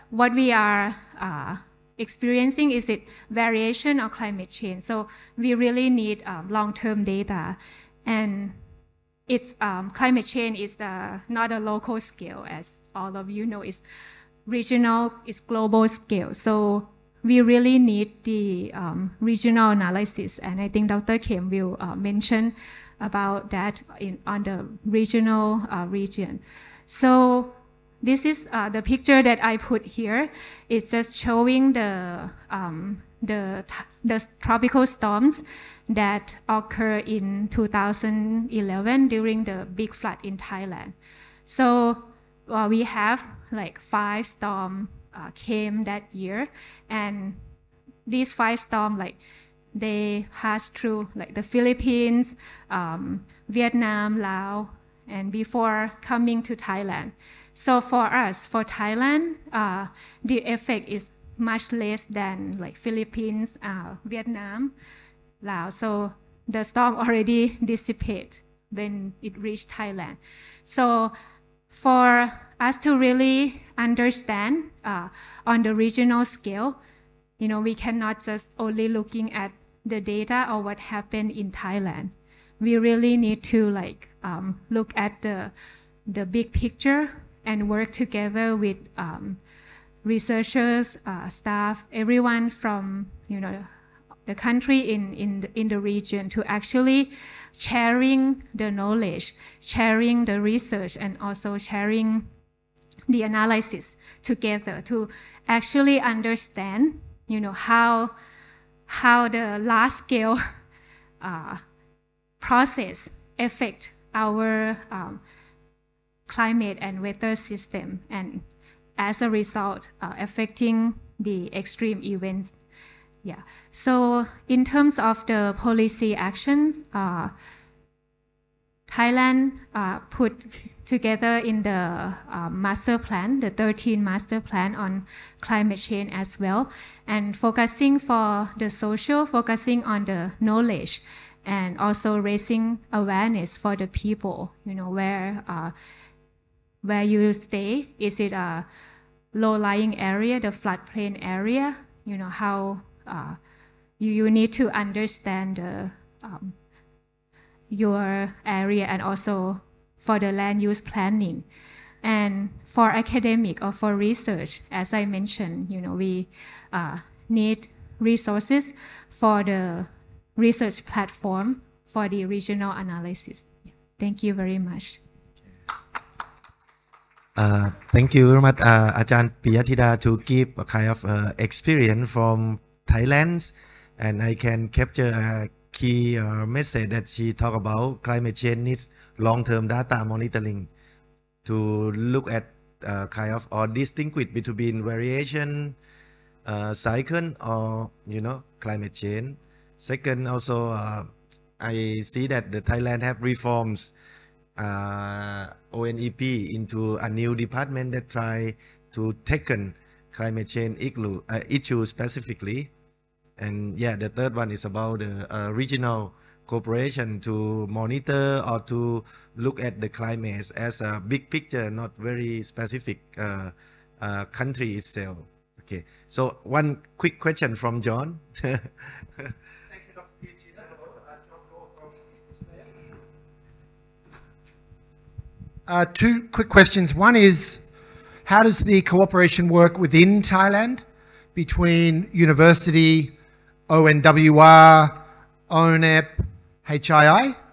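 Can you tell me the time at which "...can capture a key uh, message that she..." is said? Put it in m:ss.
3:04.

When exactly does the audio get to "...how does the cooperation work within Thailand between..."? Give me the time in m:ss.
3:58.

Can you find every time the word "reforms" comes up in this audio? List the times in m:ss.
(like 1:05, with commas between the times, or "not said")
3:23.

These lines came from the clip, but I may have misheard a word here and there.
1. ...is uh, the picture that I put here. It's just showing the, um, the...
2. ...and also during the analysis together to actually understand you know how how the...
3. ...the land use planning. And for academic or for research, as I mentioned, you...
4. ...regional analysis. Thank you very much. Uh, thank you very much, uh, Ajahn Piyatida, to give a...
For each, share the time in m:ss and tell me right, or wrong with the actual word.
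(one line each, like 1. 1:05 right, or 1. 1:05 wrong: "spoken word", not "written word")
1. 0:28 right
2. 1:40 wrong: "sharing", not "during"
3. 2:40 right
4. 2:52 right.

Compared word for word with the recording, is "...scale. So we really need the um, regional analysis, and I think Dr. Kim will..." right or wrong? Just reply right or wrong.
right.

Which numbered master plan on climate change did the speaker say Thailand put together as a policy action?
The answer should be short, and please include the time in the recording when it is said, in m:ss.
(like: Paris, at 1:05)
13th master plan, at 2:13.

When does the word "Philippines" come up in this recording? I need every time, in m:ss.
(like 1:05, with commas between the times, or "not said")
0:51, 1:02.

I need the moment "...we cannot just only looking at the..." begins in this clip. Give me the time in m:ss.
1:17.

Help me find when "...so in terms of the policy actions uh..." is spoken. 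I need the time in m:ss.
2:03.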